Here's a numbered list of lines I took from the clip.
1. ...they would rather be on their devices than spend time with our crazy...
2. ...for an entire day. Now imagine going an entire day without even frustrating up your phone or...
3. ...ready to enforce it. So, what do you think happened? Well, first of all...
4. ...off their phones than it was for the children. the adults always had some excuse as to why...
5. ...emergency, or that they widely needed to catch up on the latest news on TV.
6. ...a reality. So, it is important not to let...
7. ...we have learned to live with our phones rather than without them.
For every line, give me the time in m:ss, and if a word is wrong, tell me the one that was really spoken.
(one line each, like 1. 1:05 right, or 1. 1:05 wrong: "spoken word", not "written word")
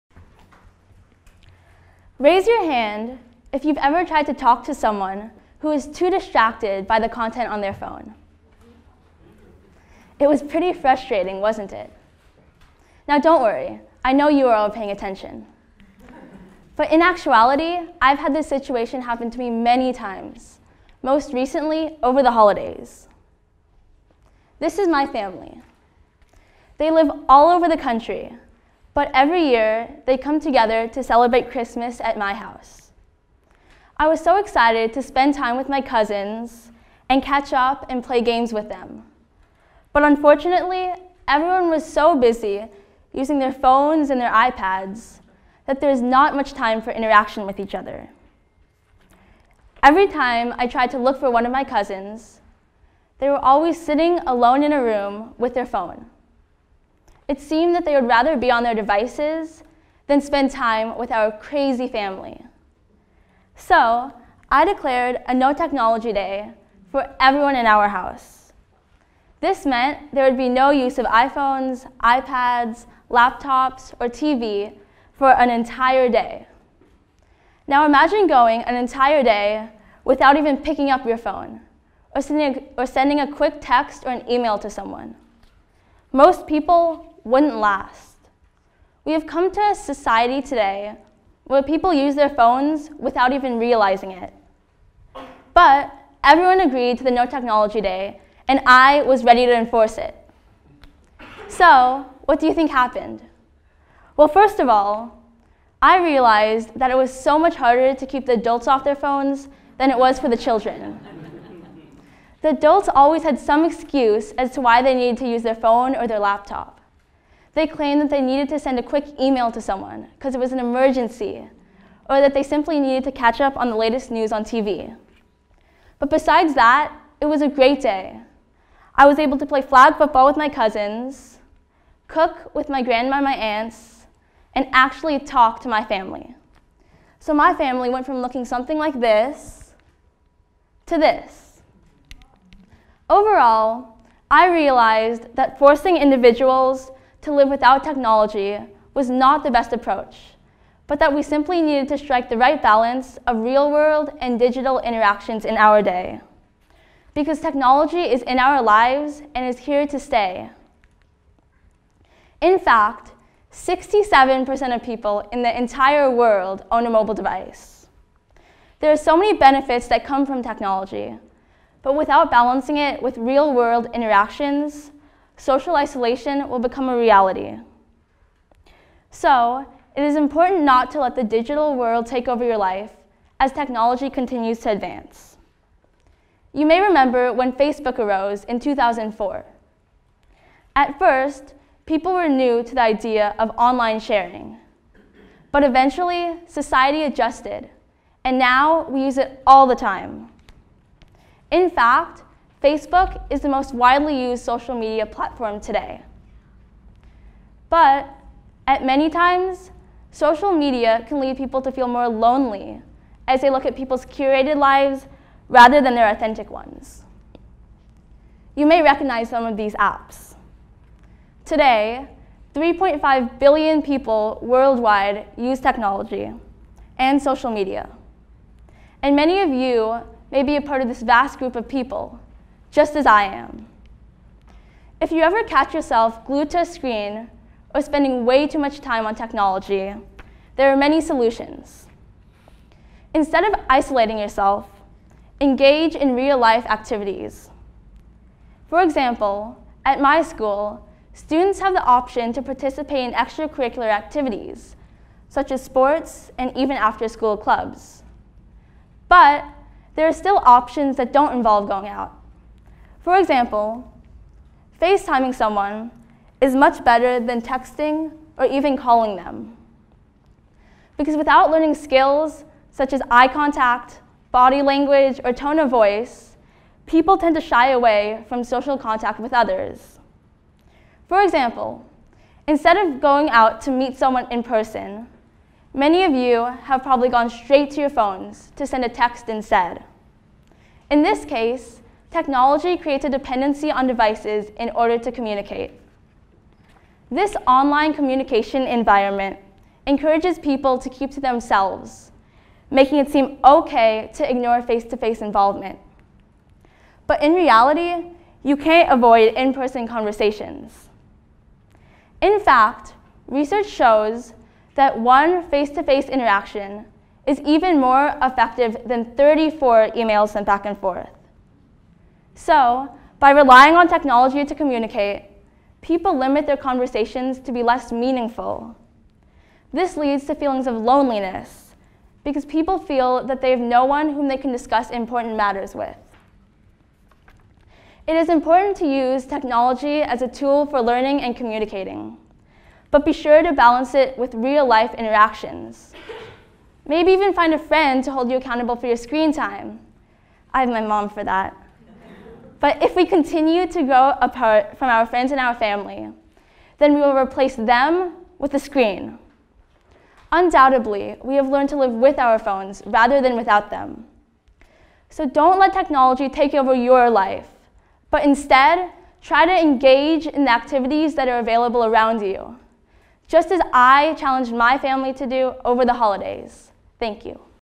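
1. 0:57 right
2. 1:15 wrong: "picking", not "frustrating"
3. 1:39 right
4. 1:48 right
5. 2:00 wrong: "simply", not "widely"
6. 2:56 right
7. 6:01 right.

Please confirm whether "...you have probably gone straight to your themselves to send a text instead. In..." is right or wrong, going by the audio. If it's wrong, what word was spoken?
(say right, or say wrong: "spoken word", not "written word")
wrong: "phones", not "themselves".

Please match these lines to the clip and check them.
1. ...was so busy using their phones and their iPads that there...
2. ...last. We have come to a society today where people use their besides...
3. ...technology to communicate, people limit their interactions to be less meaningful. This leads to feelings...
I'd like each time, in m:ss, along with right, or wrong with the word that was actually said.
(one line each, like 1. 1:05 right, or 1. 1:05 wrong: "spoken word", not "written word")
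1. 0:41 right
2. 1:27 wrong: "phones", not "besides"
3. 5:23 wrong: "conversations", not "interactions".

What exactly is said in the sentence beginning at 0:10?
It was pretty frustrating, wasn't it?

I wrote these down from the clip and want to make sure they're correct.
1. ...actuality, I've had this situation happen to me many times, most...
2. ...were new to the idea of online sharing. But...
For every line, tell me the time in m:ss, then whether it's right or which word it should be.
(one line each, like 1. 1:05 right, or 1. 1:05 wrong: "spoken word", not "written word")
1. 0:17 right
2. 3:12 right.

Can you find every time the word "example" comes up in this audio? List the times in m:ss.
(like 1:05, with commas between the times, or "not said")
4:08, 4:23, 4:41.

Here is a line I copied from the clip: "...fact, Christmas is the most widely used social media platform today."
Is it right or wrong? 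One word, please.
wrong.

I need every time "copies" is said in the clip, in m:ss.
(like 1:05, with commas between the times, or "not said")
not said.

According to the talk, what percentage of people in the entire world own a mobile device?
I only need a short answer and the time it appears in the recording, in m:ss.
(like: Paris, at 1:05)
67%, at 2:43.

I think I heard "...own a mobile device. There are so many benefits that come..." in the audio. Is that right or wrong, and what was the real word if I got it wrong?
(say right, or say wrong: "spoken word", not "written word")
right.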